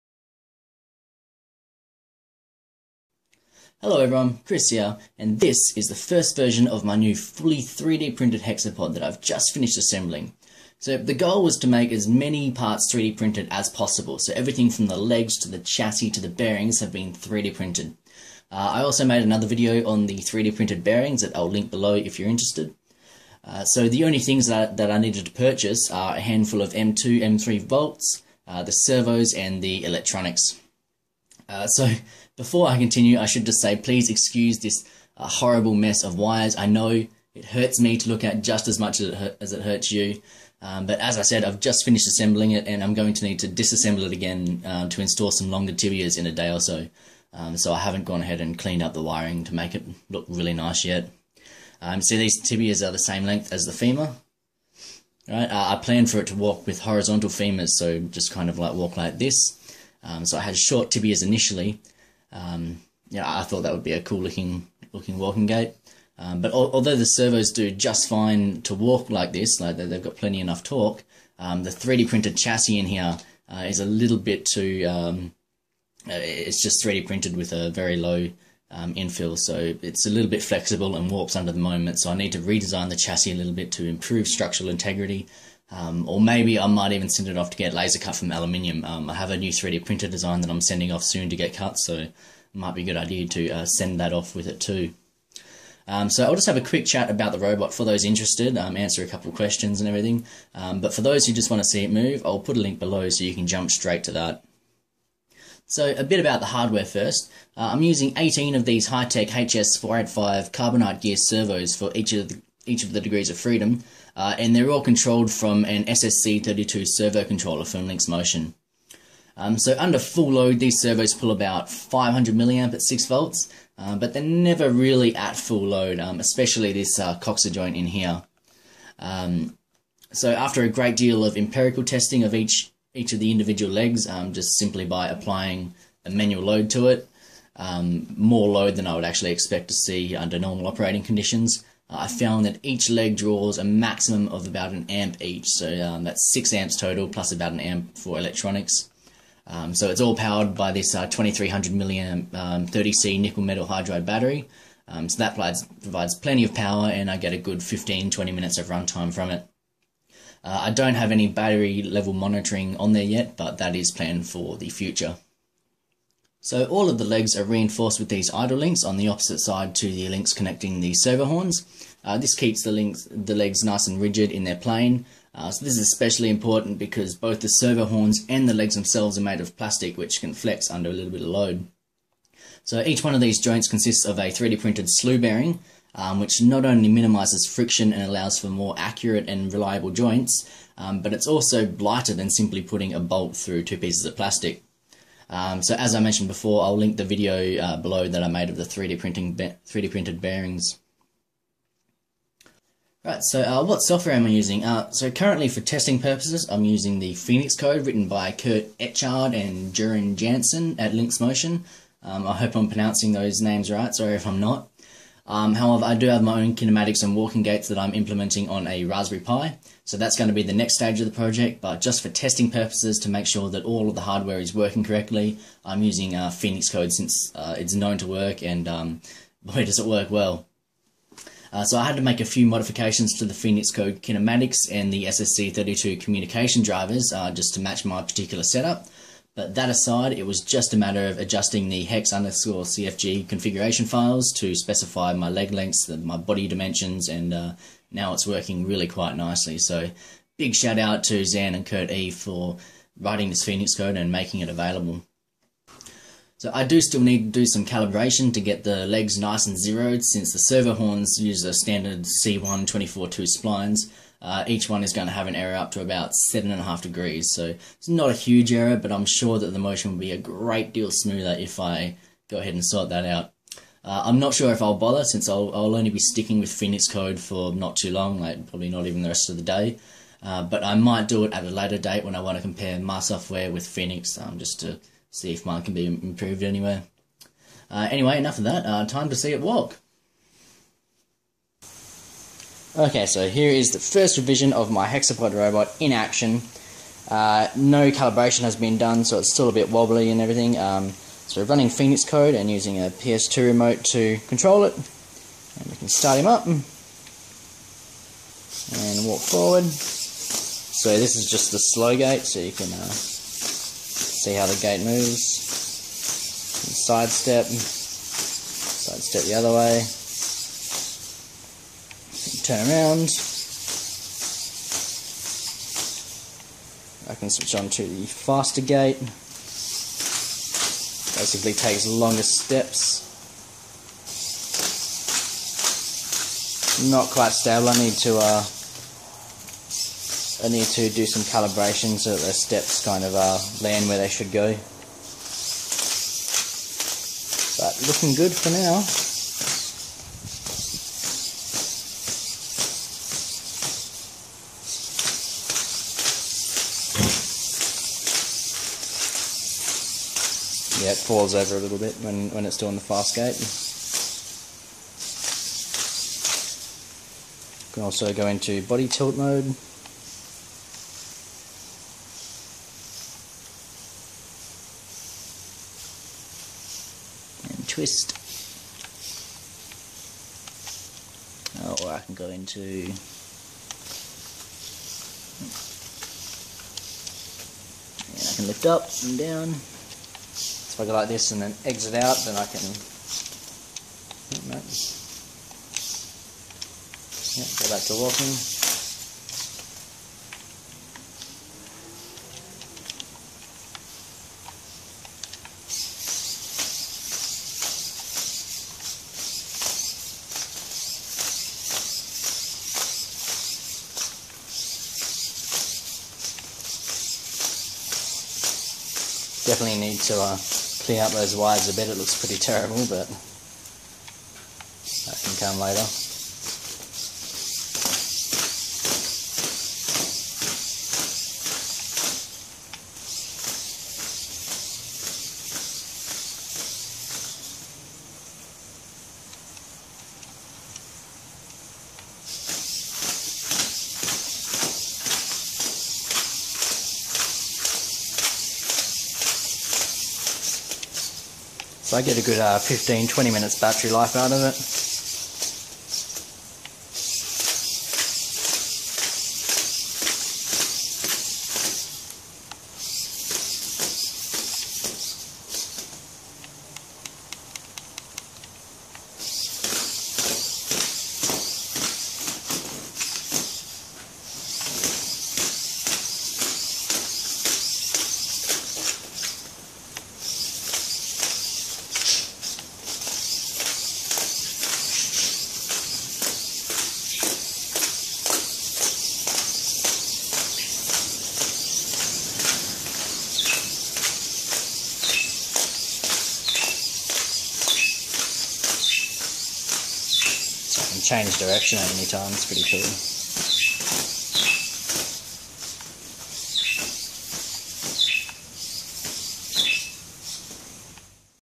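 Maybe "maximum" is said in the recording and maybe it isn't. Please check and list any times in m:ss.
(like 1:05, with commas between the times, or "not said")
2:23.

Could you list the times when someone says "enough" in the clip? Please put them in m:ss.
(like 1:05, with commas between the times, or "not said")
1:10, 4:48.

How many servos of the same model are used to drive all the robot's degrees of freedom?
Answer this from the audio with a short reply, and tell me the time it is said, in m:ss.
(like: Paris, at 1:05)
18, at 1:48.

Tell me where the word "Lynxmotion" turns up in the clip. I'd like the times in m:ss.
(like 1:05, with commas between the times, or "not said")
1:57, 3:30.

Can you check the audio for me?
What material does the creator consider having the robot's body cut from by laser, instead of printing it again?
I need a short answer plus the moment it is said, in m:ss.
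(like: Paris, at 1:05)
aluminium, at 1:28.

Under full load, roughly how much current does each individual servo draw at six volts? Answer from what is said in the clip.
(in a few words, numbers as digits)
500 milliamps.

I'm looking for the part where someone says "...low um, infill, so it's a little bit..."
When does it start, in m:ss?
1:17.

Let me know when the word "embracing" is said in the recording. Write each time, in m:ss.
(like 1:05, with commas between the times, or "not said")
not said.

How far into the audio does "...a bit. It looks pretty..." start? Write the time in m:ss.
7:01.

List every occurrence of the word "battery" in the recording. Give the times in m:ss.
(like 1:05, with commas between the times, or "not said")
2:34, 2:41, 7:33.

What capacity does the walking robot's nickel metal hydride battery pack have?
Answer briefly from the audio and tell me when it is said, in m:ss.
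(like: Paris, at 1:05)
2300 milliamps, at 2:31.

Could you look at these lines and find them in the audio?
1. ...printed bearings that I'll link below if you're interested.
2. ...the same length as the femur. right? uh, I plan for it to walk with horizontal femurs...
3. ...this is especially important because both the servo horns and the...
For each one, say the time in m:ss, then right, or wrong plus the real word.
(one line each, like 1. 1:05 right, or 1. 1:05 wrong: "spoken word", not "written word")
1. 0:20 right
2. 0:52 right
3. 2:55 right.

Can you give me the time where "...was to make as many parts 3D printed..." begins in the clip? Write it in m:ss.
0:11.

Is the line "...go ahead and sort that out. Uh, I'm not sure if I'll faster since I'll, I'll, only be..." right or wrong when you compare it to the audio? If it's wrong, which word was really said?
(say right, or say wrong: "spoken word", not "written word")
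wrong: "bother", not "faster".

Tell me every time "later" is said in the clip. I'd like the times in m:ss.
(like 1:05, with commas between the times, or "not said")
4:41, 7:05.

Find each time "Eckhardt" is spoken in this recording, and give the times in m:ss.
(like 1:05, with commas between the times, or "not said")
3:28.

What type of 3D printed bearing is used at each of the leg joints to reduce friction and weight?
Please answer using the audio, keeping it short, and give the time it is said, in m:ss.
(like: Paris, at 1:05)
slew bearing, at 3:04.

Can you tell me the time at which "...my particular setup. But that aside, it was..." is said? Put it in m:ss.
3:57.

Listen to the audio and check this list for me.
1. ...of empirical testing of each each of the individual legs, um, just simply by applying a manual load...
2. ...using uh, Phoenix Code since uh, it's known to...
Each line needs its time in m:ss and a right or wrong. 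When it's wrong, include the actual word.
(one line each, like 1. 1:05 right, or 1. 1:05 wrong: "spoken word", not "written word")
1. 2:11 right
2. 3:45 right.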